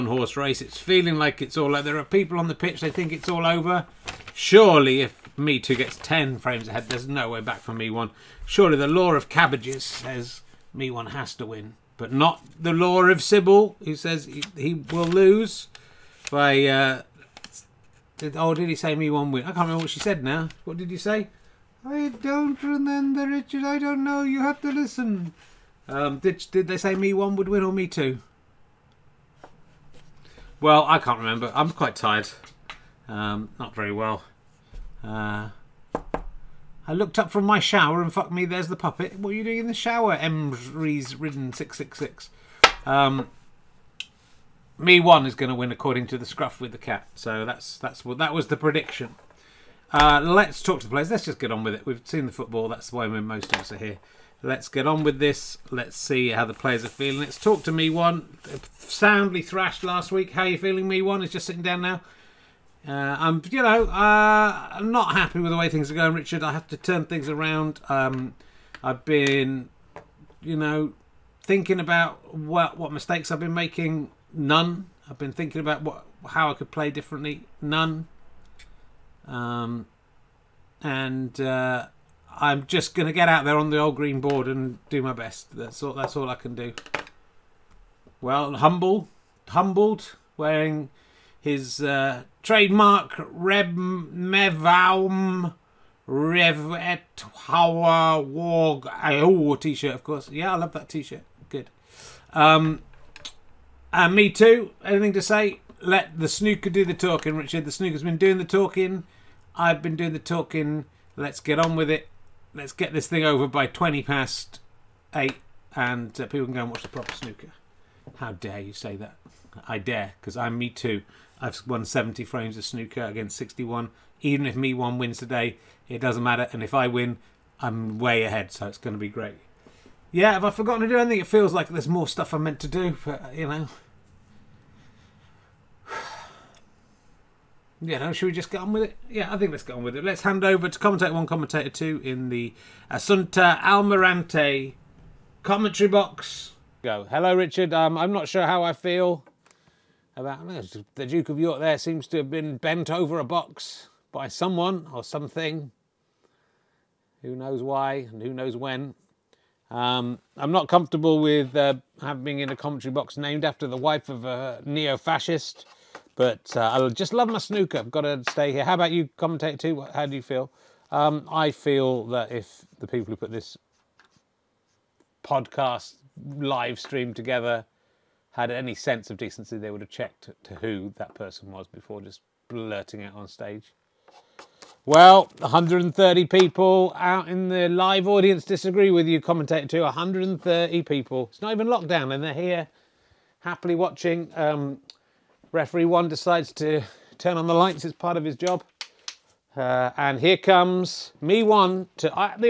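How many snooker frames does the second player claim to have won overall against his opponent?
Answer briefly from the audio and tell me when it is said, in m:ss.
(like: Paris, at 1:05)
70, at 2:01.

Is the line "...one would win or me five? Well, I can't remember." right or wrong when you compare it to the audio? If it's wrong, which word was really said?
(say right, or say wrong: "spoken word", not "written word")
wrong: "two", not "five".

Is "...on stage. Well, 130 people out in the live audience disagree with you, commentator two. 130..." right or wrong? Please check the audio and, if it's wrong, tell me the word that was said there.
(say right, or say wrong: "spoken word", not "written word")
right.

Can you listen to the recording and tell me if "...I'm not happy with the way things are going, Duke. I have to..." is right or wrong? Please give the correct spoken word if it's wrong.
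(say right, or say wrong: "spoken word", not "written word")
wrong: "Richard", not "Duke".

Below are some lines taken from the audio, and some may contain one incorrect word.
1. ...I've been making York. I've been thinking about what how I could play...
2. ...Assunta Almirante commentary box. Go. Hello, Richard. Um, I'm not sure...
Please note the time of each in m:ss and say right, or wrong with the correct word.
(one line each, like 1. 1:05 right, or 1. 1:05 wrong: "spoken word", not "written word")
1. 1:13 wrong: "None", not "York"
2. 2:22 right.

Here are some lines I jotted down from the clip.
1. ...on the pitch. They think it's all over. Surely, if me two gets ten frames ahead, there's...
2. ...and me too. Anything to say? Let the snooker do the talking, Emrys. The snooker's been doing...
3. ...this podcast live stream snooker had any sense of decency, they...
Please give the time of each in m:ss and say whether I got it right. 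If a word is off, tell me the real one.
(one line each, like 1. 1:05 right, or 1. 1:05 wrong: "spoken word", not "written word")
1. 0:02 right
2. 1:43 wrong: "Richard", not "Emrys"
3. 2:53 wrong: "together", not "snooker".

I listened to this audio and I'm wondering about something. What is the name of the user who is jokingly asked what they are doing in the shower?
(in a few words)
Emrys Ridden 666.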